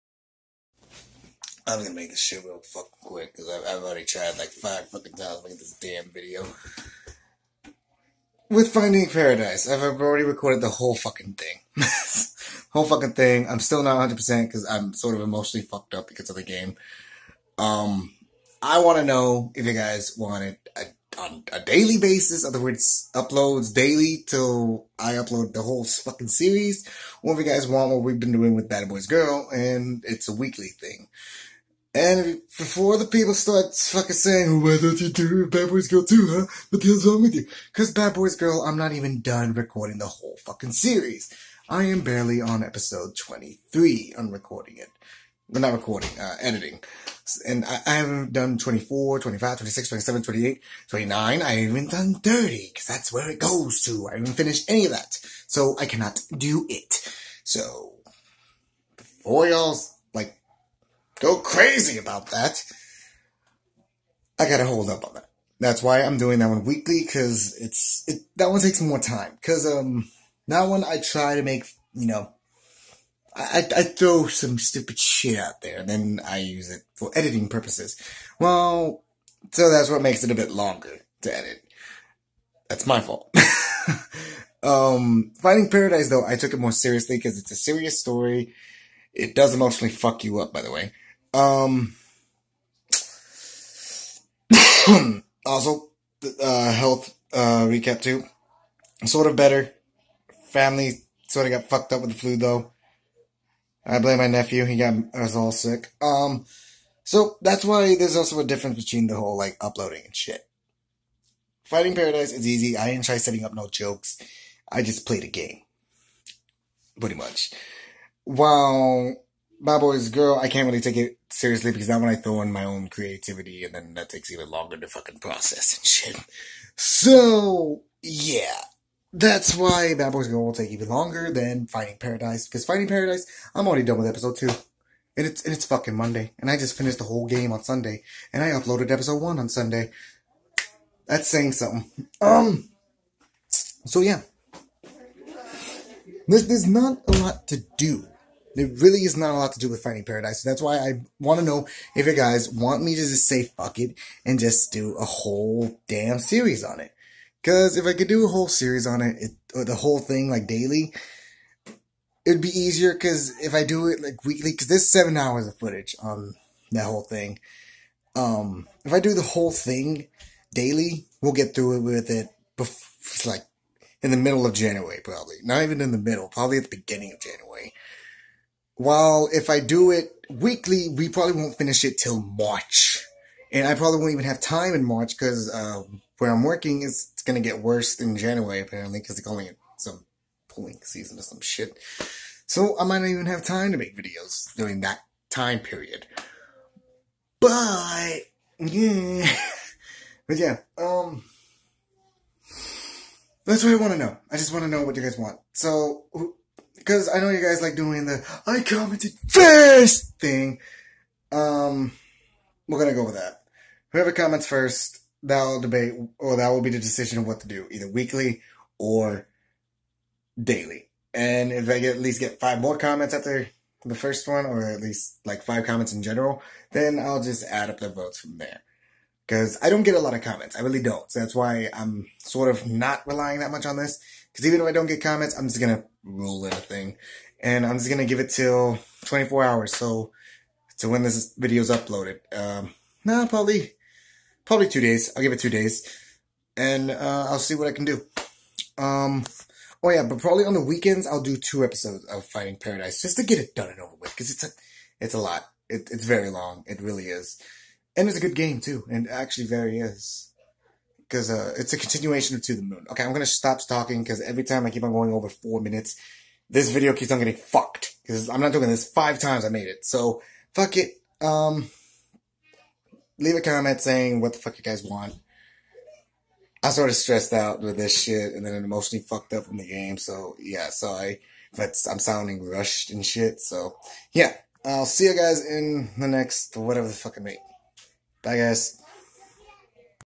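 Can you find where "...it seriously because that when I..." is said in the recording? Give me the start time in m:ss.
2:00.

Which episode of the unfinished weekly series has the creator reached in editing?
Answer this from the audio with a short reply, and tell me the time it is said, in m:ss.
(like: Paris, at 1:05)
23, at 0:42.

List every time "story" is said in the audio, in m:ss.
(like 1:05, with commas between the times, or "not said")
1:27.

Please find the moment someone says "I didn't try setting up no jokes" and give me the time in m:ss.
1:52.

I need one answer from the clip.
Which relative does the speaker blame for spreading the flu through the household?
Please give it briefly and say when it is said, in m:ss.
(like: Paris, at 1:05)
nephew, at 1:44.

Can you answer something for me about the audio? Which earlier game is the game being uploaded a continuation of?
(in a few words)
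To the Moon.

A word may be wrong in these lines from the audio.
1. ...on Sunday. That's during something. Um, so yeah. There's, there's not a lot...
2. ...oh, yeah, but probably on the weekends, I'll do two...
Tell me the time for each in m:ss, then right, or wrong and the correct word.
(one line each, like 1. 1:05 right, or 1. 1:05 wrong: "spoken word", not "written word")
1. 2:19 wrong: "saying", not "during"
2. 4:09 right.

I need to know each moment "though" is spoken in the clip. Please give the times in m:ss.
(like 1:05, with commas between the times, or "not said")
1:26, 1:42.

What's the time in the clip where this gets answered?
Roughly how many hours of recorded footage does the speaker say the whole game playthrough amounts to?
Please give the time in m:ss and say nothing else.
2:44.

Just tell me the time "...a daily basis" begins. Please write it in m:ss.
0:21.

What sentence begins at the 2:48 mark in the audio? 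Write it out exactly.
Um, if I do the whole thing daily, we'll get through it with it.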